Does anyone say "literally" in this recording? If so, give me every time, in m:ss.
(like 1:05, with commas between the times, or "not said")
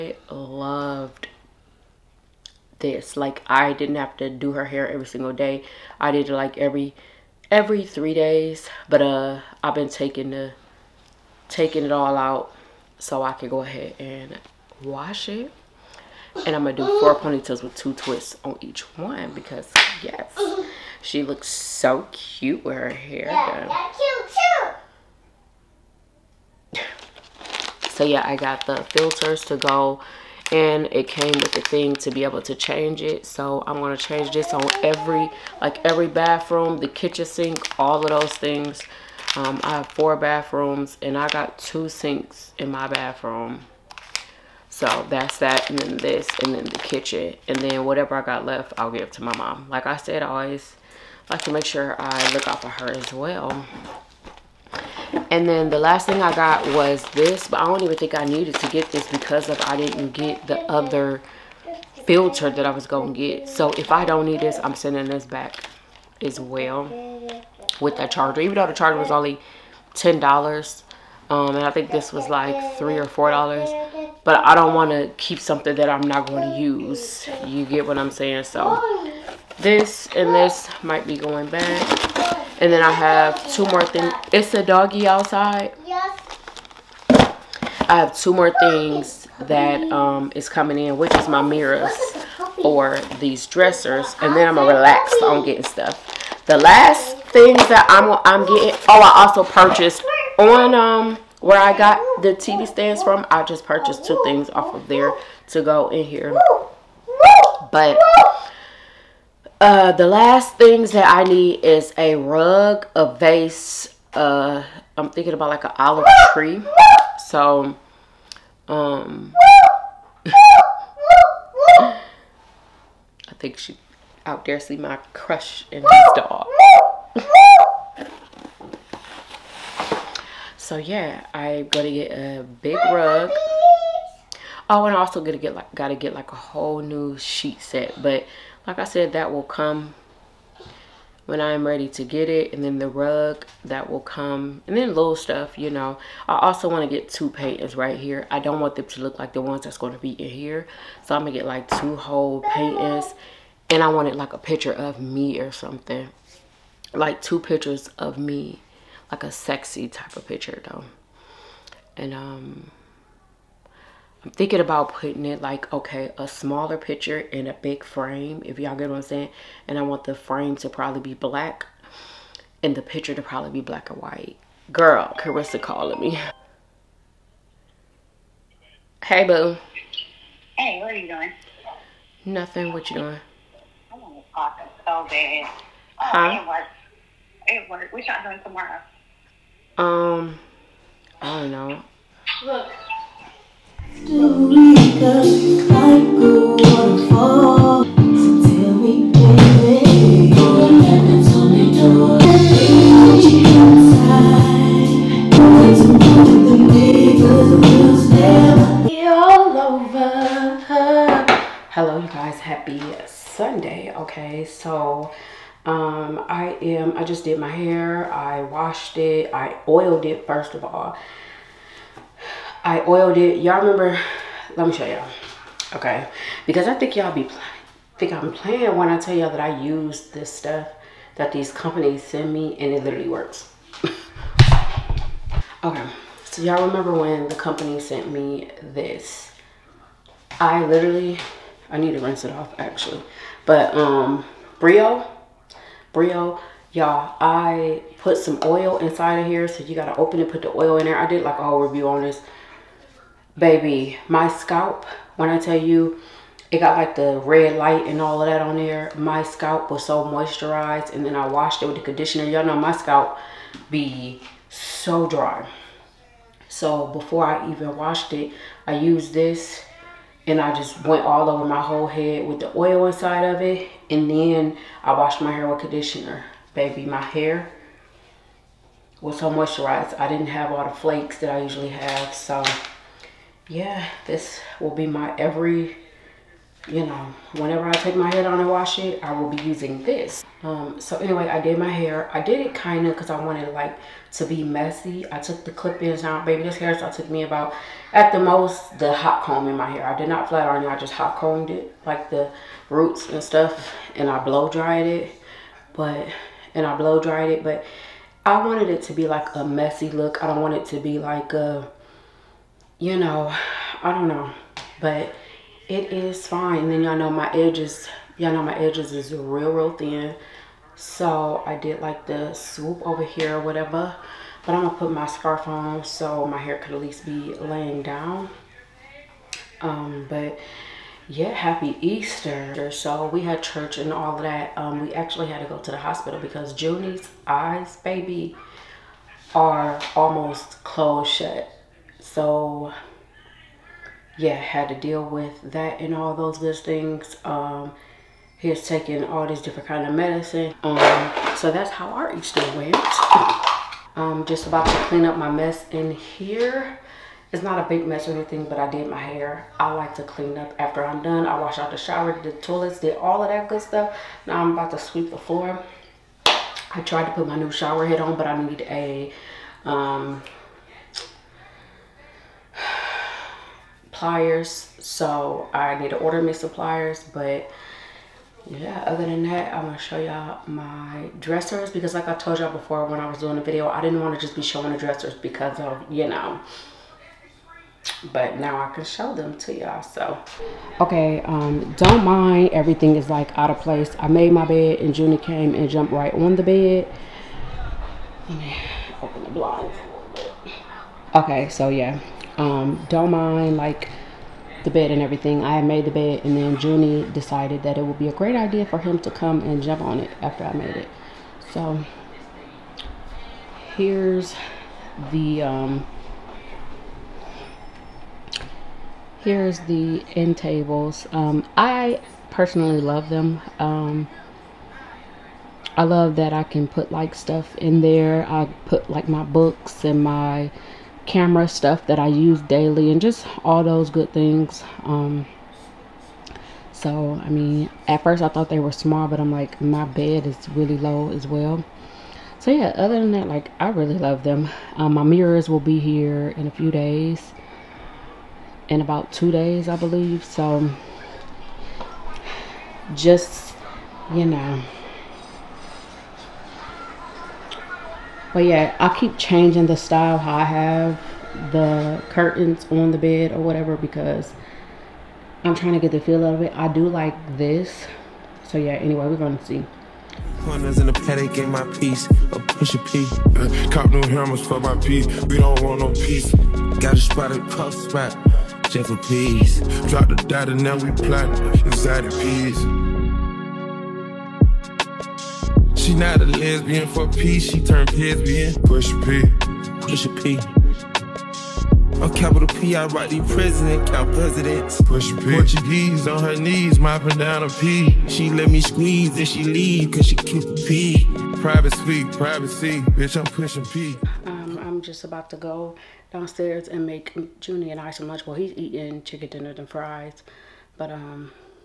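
3:52, 4:00.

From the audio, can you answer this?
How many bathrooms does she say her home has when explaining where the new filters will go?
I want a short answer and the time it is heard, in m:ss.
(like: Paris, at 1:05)
4, at 0:39.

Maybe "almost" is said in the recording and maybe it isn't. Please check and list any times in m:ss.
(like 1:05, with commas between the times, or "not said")
5:39.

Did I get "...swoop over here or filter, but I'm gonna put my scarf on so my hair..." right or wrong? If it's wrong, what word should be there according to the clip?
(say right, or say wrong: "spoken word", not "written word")
wrong: "whatever", not "filter".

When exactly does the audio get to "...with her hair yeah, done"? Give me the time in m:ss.
0:22.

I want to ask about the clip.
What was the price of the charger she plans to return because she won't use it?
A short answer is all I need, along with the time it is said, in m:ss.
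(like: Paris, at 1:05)
$10, at 1:09.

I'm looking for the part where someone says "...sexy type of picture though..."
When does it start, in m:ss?
2:39.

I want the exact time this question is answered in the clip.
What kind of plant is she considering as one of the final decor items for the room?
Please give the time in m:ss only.
1:55.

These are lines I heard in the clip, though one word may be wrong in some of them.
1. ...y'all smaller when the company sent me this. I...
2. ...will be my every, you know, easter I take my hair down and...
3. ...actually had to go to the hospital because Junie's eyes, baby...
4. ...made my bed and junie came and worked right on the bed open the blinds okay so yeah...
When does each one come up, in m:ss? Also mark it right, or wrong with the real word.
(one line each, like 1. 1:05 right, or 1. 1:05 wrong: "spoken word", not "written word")
1. 3:56 wrong: "remember", not "smaller"
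2. 4:44 wrong: "whenever", not "easter"
3. 5:34 right
4. 6:34 wrong: "jumped", not "worked".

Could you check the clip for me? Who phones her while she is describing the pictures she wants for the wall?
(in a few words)
Carissa.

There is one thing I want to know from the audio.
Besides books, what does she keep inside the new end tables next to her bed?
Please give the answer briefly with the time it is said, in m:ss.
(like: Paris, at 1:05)
Camera stuff, at 7:11.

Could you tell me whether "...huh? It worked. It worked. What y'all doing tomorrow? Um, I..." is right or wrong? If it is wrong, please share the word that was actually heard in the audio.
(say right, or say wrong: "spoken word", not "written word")
right.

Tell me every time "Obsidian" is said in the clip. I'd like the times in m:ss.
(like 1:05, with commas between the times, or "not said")
not said.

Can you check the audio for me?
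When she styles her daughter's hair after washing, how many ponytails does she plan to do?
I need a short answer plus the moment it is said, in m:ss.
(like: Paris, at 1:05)
4, at 0:16.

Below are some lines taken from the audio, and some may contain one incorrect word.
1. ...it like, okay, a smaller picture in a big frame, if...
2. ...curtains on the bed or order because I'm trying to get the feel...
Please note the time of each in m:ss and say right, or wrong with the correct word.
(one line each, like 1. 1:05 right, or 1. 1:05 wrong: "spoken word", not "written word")
1. 2:45 right
2. 7:42 wrong: "whatever", not "order".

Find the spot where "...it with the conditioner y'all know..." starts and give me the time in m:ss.
4:21.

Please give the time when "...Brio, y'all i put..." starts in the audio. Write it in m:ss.
4:05.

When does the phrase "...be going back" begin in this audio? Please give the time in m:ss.
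1:21.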